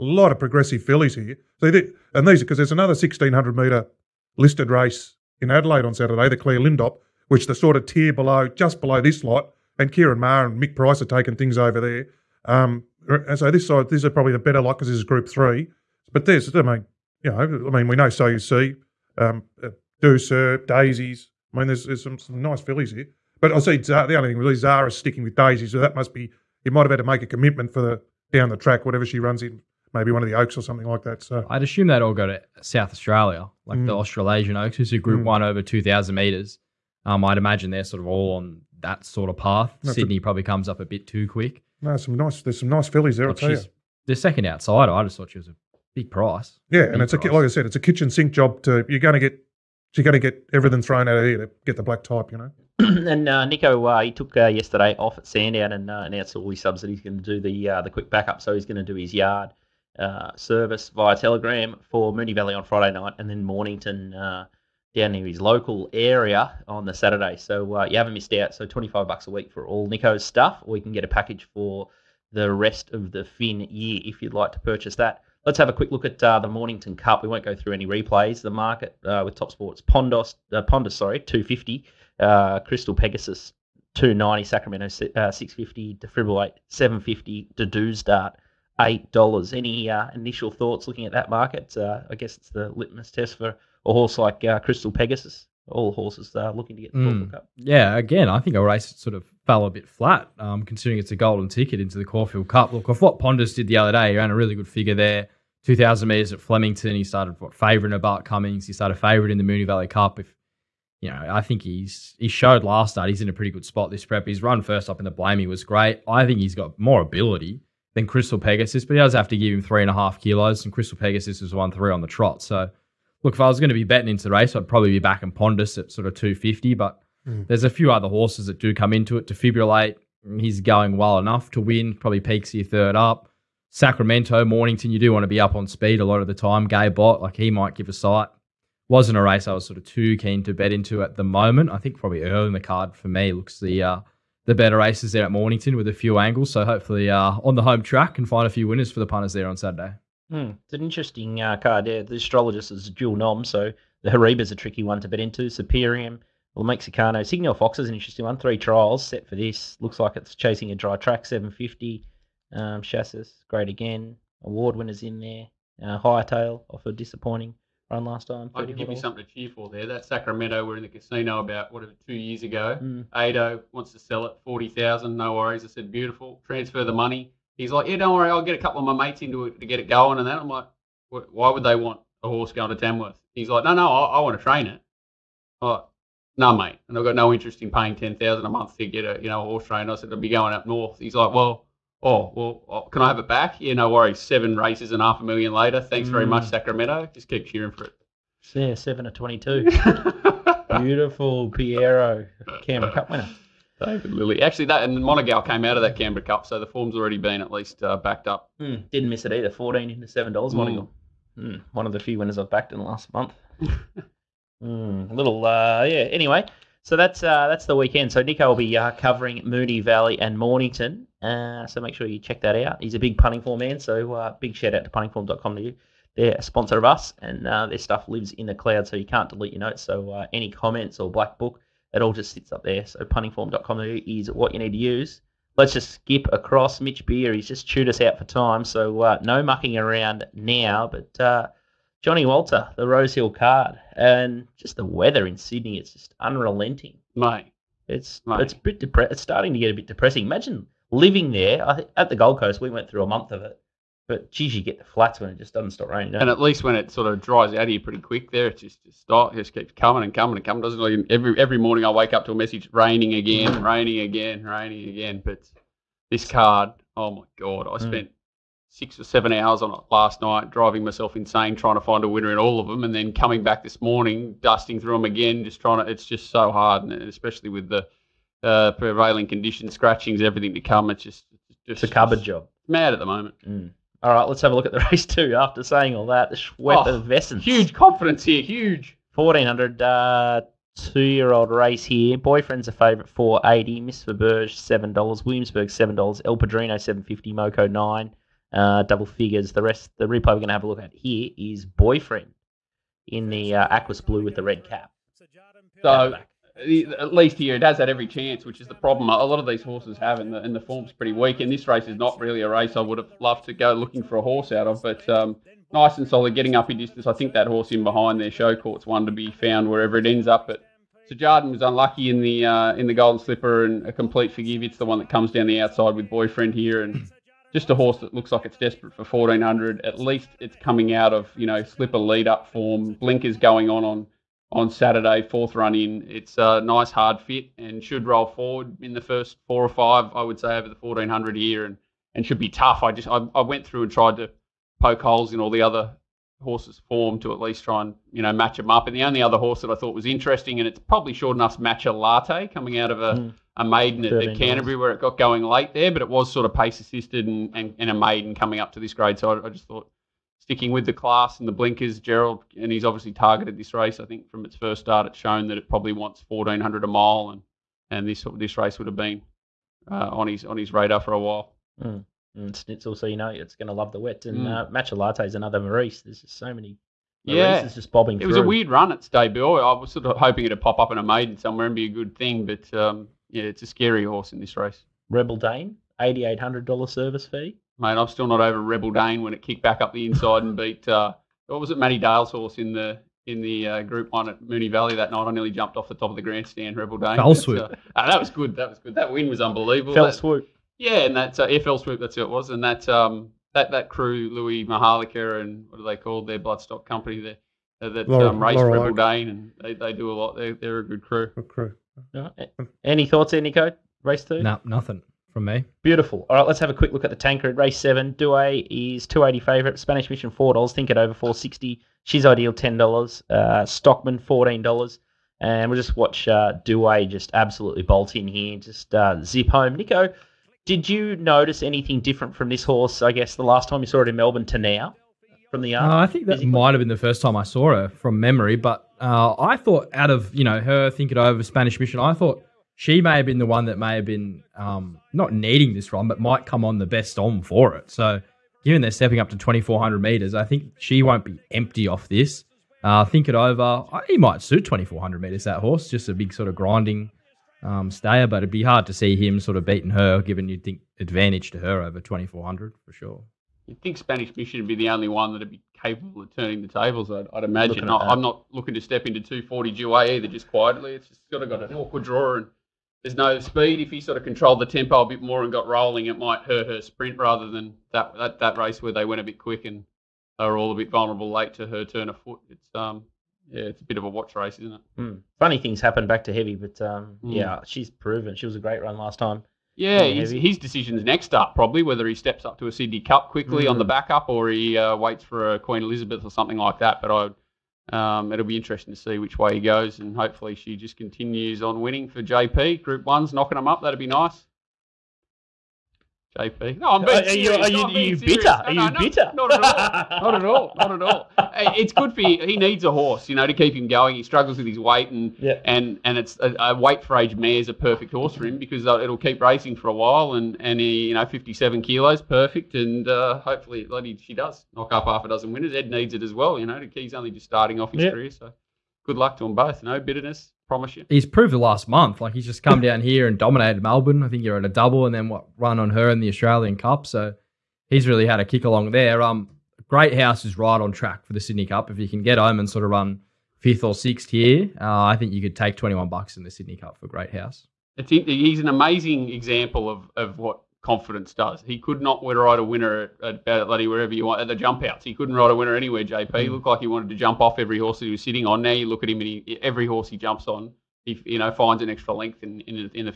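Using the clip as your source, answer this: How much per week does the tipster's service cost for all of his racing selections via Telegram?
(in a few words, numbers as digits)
$25.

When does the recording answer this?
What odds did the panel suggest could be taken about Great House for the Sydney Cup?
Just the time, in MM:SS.
09:05.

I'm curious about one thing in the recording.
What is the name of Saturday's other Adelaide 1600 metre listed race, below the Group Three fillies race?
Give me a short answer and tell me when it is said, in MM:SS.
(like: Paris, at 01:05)
Clare Lindop, at 00:06.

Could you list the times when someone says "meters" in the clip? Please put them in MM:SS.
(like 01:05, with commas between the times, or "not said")
00:03, 00:36, 07:30, 07:35.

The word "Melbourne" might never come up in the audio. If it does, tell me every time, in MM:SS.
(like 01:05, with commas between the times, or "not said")
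07:14, 08:53.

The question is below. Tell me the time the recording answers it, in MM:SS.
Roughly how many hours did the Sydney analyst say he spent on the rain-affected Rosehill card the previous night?
04:28.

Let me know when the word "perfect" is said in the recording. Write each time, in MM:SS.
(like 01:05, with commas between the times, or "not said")
08:37, 08:42.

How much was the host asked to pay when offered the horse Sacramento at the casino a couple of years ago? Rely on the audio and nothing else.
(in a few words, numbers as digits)
$40,000.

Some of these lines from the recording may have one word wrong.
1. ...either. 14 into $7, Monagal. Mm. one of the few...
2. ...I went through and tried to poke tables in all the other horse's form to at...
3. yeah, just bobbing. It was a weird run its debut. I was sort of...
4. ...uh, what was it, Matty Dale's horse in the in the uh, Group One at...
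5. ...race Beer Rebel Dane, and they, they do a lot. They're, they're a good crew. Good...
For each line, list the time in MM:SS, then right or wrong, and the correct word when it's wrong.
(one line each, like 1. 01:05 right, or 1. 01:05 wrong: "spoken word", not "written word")
1. 03:29 right
2. 05:43 wrong: "holes", not "tables"
3. 06:17 right
4. 06:30 right
5. 06:48 wrong: "Laura", not "Beer".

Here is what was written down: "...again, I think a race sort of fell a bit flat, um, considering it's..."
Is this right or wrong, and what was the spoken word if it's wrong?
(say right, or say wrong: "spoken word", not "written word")
right.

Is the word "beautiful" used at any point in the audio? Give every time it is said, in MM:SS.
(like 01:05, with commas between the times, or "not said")
02:55, 03:20, 06:55.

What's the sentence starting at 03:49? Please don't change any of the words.
So uh, any comments or black book, it all just sits up there.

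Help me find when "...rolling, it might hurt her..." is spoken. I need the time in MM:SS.
07:55.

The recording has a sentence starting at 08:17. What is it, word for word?
But I, um, it'll be interesting to see which way he goes, and hopefully she just continues on winning for JP.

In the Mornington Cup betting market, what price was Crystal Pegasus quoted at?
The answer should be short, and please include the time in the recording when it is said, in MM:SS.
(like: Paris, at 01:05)
$2.90, at 01:23.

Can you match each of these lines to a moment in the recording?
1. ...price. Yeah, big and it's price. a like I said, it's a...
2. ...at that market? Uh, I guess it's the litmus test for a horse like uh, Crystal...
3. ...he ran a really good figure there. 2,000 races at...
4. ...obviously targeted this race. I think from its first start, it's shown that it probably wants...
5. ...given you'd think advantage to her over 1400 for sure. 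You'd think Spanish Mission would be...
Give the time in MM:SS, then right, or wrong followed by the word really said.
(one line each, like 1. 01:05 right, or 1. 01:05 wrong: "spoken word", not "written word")
1. 00:46 right
2. 01:31 right
3. 01:44 wrong: "metres", not "races"
4. 06:02 right
5. 07:40 wrong: "2400", not "1400".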